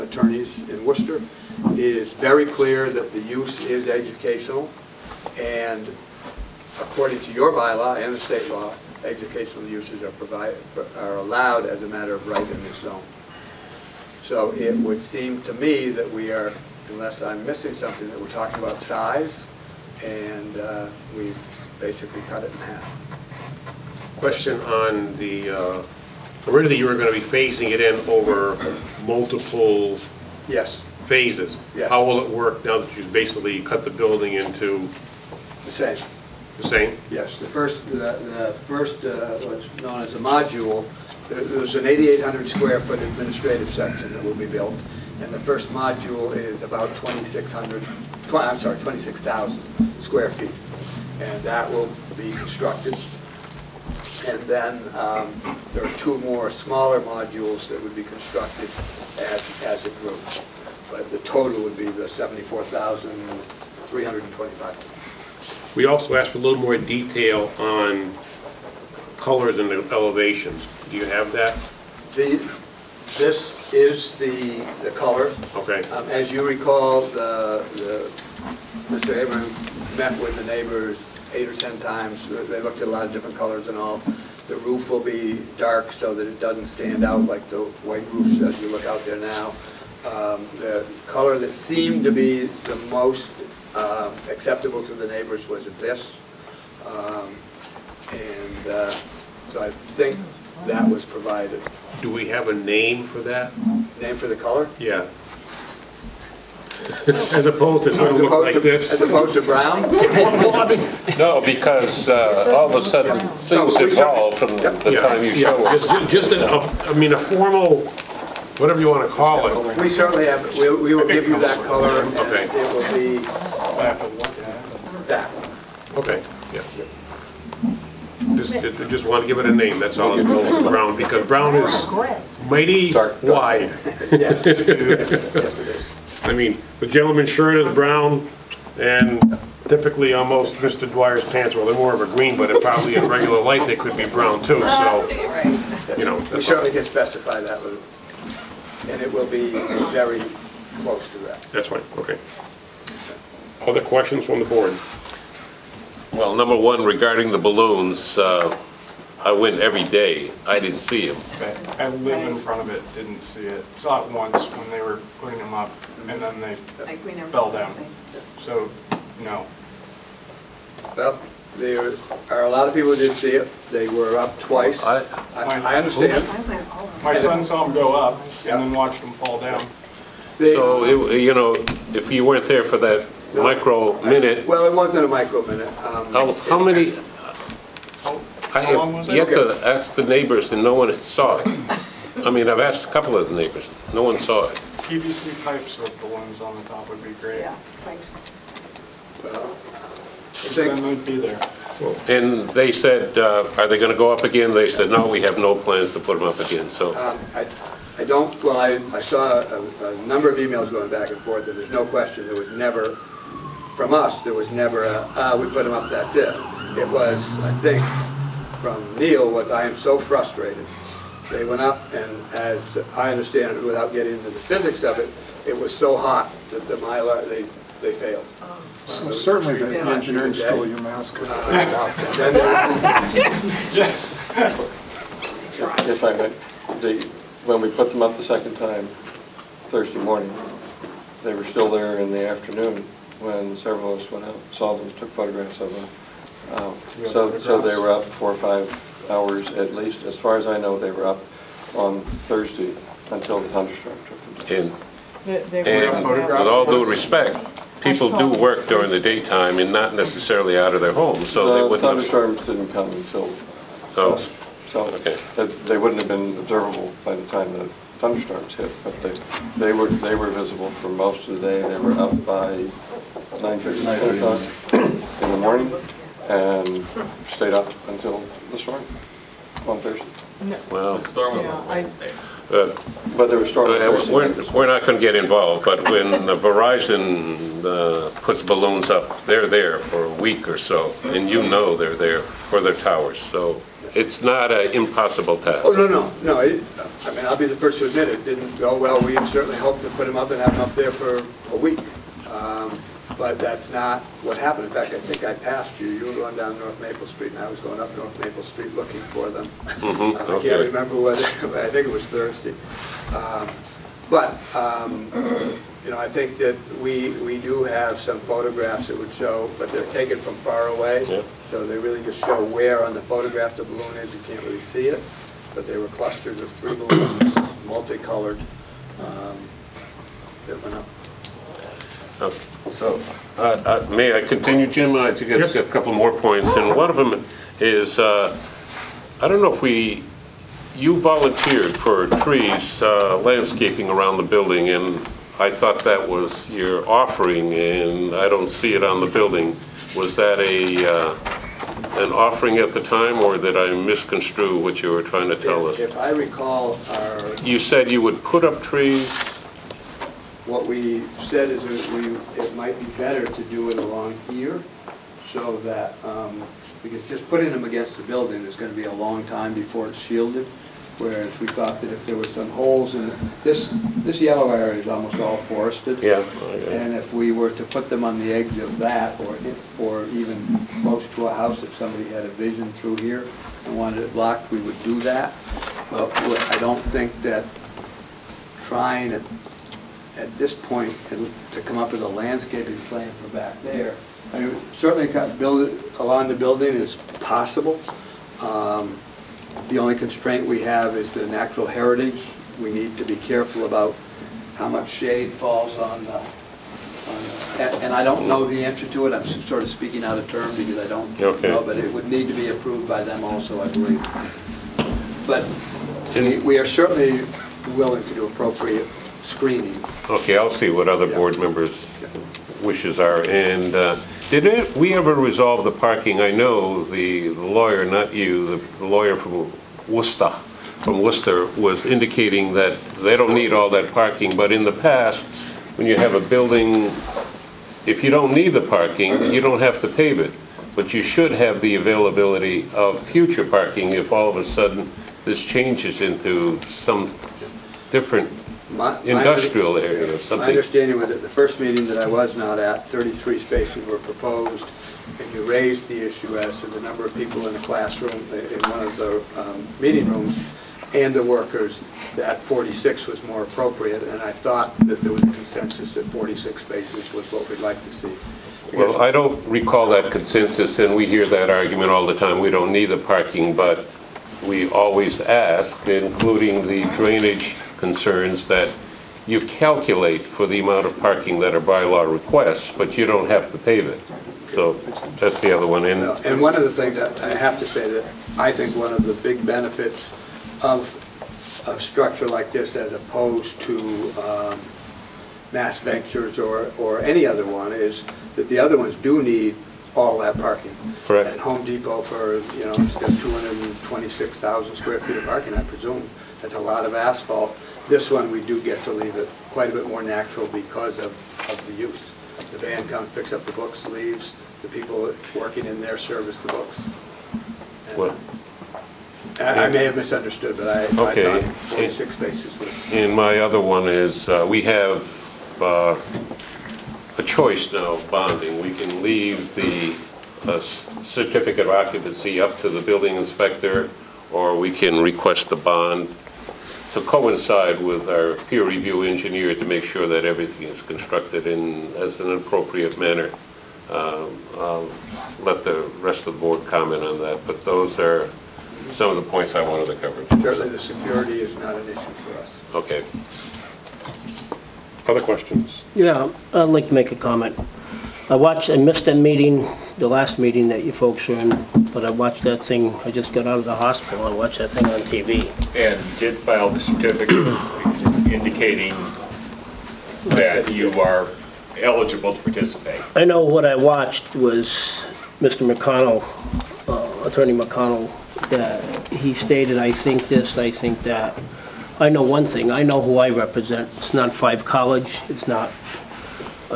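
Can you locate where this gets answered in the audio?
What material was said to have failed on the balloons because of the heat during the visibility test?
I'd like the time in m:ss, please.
3:46.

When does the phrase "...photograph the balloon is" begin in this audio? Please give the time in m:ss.
5:23.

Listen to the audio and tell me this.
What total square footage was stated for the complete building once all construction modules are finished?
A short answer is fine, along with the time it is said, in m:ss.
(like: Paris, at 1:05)
74,325, at 1:02.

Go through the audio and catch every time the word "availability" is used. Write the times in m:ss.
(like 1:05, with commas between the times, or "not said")
7:21.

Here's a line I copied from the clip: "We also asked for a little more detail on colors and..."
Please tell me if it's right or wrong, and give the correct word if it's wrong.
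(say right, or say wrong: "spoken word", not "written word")
right.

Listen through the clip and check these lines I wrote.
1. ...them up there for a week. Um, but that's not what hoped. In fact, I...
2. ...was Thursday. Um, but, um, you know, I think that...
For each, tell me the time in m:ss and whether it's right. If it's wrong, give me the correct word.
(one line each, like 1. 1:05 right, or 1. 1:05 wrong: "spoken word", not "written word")
1. 5:00 wrong: "happened", not "hoped"
2. 5:11 right.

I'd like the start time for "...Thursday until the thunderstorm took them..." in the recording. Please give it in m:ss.
4:12.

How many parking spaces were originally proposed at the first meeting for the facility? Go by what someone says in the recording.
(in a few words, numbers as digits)
33.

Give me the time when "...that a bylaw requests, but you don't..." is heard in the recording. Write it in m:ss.
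8:01.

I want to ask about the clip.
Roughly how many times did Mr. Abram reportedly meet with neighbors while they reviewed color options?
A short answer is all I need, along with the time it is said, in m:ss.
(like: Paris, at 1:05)
8 or 10, at 1:21.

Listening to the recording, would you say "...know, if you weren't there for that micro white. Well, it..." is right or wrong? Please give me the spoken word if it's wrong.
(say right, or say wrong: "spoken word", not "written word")
wrong: "minute", not "white".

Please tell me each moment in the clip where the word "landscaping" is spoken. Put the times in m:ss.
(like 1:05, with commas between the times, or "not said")
5:43, 6:32.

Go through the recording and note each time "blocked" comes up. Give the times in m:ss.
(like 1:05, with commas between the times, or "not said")
6:24.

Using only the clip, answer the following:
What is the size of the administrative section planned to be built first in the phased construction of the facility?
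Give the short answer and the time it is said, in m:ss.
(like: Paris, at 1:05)
8,800 square feet, at 0:41.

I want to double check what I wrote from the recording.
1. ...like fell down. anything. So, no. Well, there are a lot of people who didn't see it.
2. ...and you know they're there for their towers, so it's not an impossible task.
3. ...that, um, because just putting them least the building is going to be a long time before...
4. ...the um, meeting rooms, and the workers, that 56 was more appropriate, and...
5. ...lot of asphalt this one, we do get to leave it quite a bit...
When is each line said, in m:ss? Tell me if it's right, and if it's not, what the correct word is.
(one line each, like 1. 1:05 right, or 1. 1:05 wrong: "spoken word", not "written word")
1. 2:46 right
2. 4:51 right
3. 6:05 wrong: "against", not "least"
4. 7:38 wrong: "46", not "56"
5. 8:26 right.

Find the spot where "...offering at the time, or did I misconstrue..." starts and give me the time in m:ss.
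5:52.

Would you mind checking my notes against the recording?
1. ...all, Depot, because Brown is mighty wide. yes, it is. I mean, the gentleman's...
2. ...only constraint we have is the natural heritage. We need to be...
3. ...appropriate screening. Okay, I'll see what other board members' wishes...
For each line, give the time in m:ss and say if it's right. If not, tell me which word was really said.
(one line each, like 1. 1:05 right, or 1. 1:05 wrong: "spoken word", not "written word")
1. 2:09 wrong: "Brown", not "Depot"
2. 6:39 right
3. 6:58 right.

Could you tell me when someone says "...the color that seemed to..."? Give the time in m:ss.
1:30.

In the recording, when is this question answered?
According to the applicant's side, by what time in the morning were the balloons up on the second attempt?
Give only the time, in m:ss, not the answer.
4:33.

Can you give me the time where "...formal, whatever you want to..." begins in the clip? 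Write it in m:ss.
1:57.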